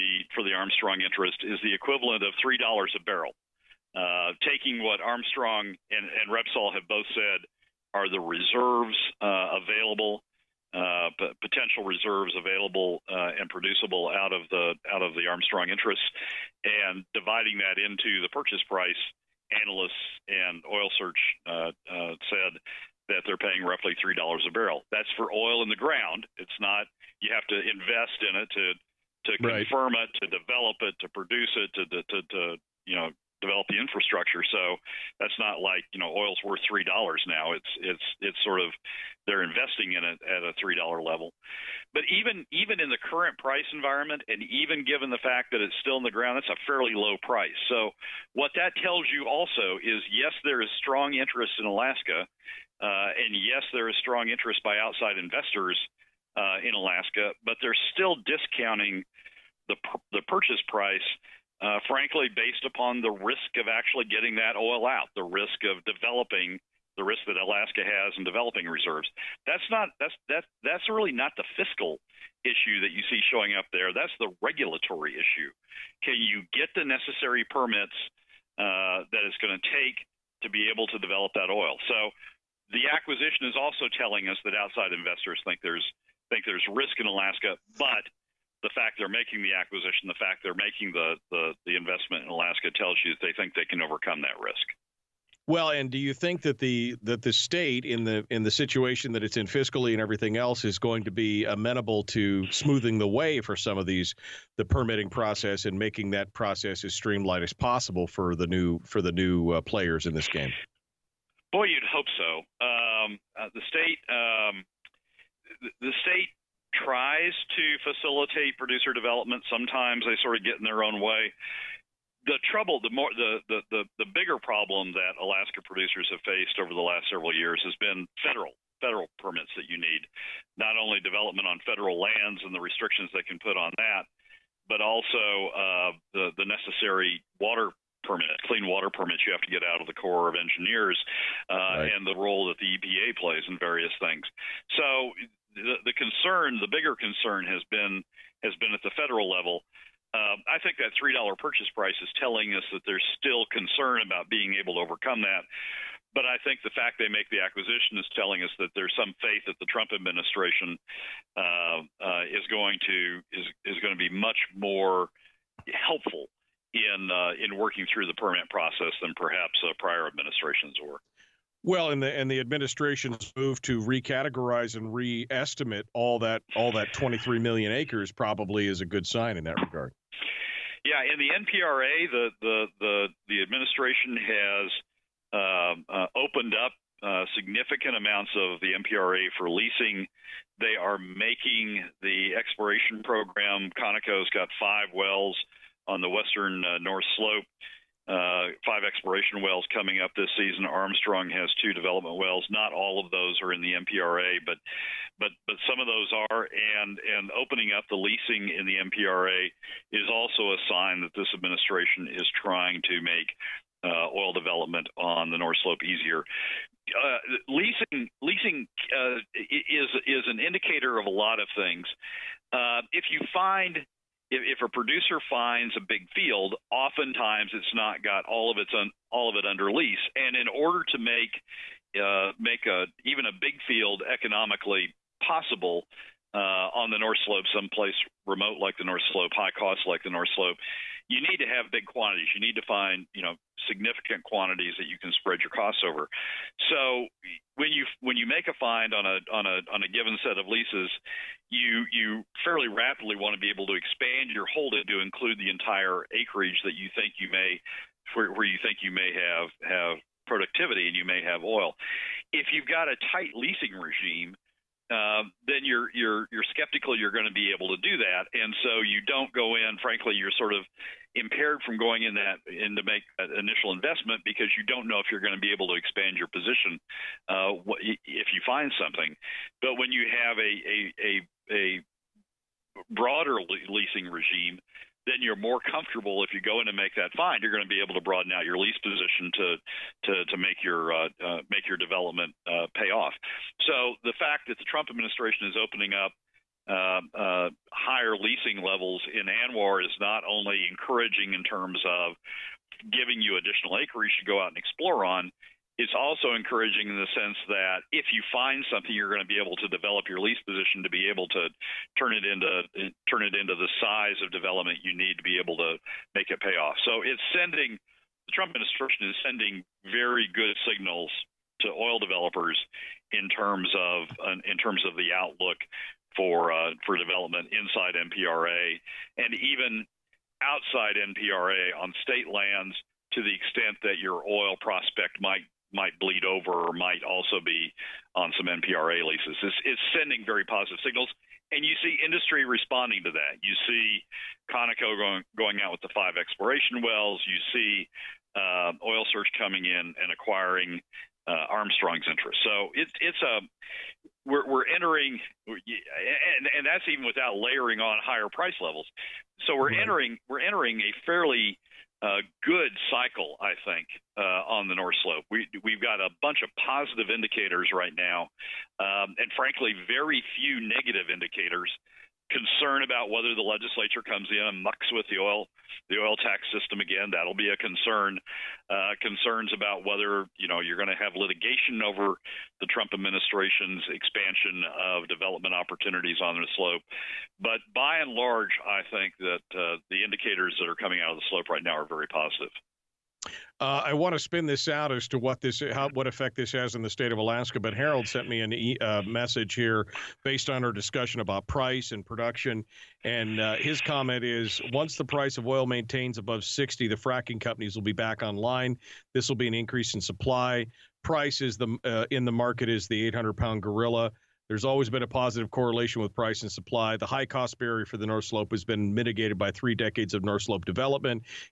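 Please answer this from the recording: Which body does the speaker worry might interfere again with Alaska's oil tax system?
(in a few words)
the legislature.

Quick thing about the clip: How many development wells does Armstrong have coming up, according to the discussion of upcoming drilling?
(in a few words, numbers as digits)
2.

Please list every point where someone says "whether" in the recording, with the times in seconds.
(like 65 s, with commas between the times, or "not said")
373 s, 379 s.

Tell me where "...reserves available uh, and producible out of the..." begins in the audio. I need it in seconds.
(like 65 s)
11 s.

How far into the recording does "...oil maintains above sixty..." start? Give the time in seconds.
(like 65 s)
405 s.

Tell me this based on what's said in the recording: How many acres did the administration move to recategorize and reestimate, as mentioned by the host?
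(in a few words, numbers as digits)
23 million.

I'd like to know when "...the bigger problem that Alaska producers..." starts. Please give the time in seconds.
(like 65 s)
124 s.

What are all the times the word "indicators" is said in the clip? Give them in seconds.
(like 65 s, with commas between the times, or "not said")
220 s, 367 s, 371 s, 390 s.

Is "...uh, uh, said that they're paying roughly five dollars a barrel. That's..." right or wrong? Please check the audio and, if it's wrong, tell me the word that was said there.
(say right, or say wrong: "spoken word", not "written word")
wrong: "three", not "five".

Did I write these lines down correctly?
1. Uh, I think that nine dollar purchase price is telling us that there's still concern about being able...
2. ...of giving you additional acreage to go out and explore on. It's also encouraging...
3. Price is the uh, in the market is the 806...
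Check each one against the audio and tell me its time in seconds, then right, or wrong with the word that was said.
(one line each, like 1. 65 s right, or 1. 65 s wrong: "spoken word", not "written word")
1. 150 s wrong: "three", not "nine"
2. 301 s right
3. 411 s wrong: "800", not "806".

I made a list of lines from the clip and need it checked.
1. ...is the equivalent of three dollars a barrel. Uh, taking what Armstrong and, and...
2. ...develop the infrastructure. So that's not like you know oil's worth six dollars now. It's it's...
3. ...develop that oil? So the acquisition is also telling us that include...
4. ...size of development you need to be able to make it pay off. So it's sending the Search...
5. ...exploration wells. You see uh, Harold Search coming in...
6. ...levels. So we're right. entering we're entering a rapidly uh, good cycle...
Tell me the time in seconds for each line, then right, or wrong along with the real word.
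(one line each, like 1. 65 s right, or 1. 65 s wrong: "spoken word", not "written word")
1. 1 s right
2. 33 s wrong: "three", not "six"
3. 80 s wrong: "outside", not "include"
4. 313 s wrong: "Trump", not "Search"
5. 346 s wrong: "Oil", not "Harold"
6. 358 s wrong: "fairly", not "rapidly".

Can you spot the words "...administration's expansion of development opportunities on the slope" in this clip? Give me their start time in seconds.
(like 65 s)
382 s.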